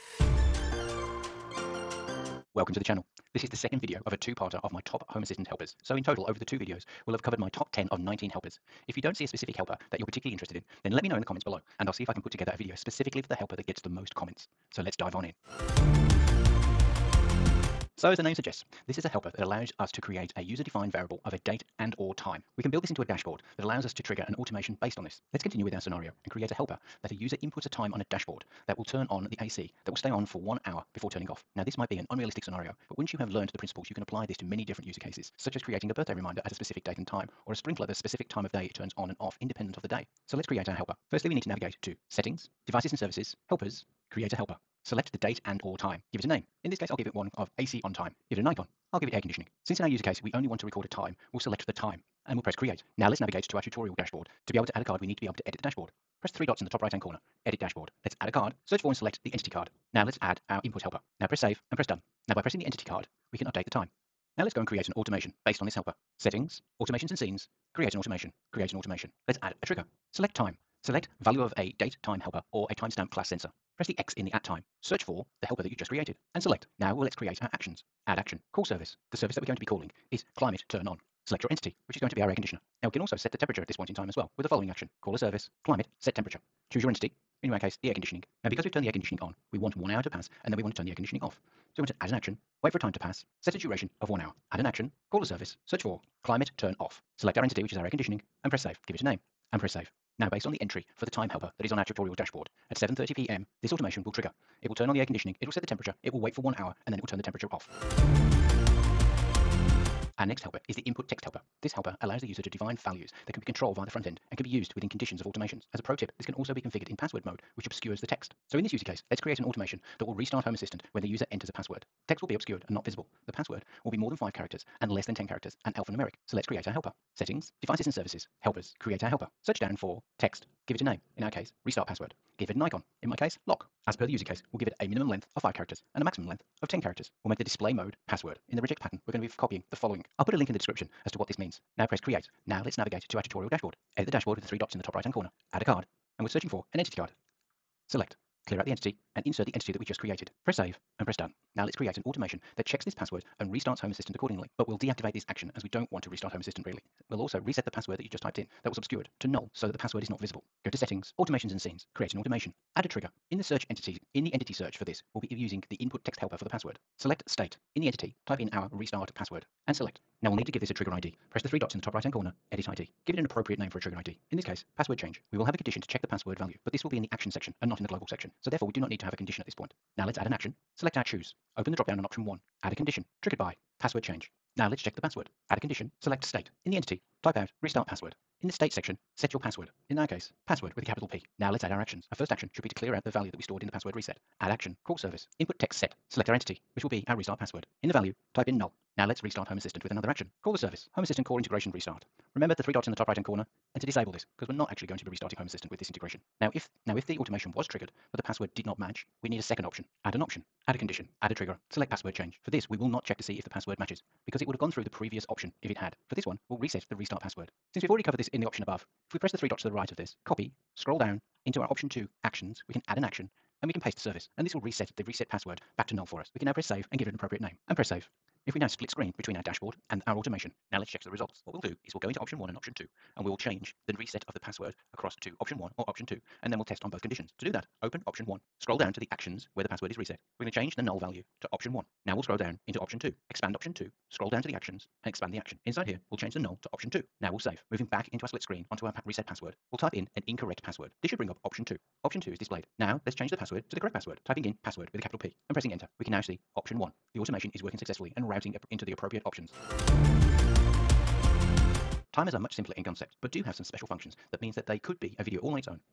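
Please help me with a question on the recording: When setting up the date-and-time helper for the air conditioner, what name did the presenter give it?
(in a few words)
AC on time.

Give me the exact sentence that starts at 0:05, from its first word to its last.
So in total, over the two videos, we'll have covered my top 10 of 19 helpers.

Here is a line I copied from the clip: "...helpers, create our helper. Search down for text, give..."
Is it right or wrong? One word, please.
right.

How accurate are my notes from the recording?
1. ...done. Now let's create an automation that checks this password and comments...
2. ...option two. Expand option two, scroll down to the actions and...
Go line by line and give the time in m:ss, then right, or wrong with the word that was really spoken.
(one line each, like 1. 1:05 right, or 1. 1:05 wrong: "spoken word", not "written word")
1. 2:31 wrong: "restarts", not "comments"
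2. 4:02 right.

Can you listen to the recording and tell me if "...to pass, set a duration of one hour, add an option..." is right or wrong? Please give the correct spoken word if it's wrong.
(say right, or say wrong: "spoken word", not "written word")
wrong: "action", not "option".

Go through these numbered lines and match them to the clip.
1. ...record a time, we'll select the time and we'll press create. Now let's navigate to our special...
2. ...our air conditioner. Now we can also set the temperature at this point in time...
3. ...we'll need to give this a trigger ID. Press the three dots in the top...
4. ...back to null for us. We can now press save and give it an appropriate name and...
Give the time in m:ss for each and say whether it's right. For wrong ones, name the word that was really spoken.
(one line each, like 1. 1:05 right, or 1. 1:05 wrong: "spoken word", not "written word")
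1. 0:50 wrong: "tutorial", not "special"
2. 1:22 right
3. 2:50 right
4. 3:45 right.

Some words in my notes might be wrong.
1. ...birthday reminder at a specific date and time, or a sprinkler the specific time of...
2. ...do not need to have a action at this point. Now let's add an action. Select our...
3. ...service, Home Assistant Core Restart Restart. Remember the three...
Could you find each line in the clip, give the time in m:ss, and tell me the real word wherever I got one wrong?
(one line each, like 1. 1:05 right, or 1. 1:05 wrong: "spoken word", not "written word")
1. 0:35 right
2. 2:58 wrong: "condition", not "action"
3. 3:20 wrong: "Integration", not "Restart".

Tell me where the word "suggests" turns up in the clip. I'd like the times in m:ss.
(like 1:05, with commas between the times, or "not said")
0:18.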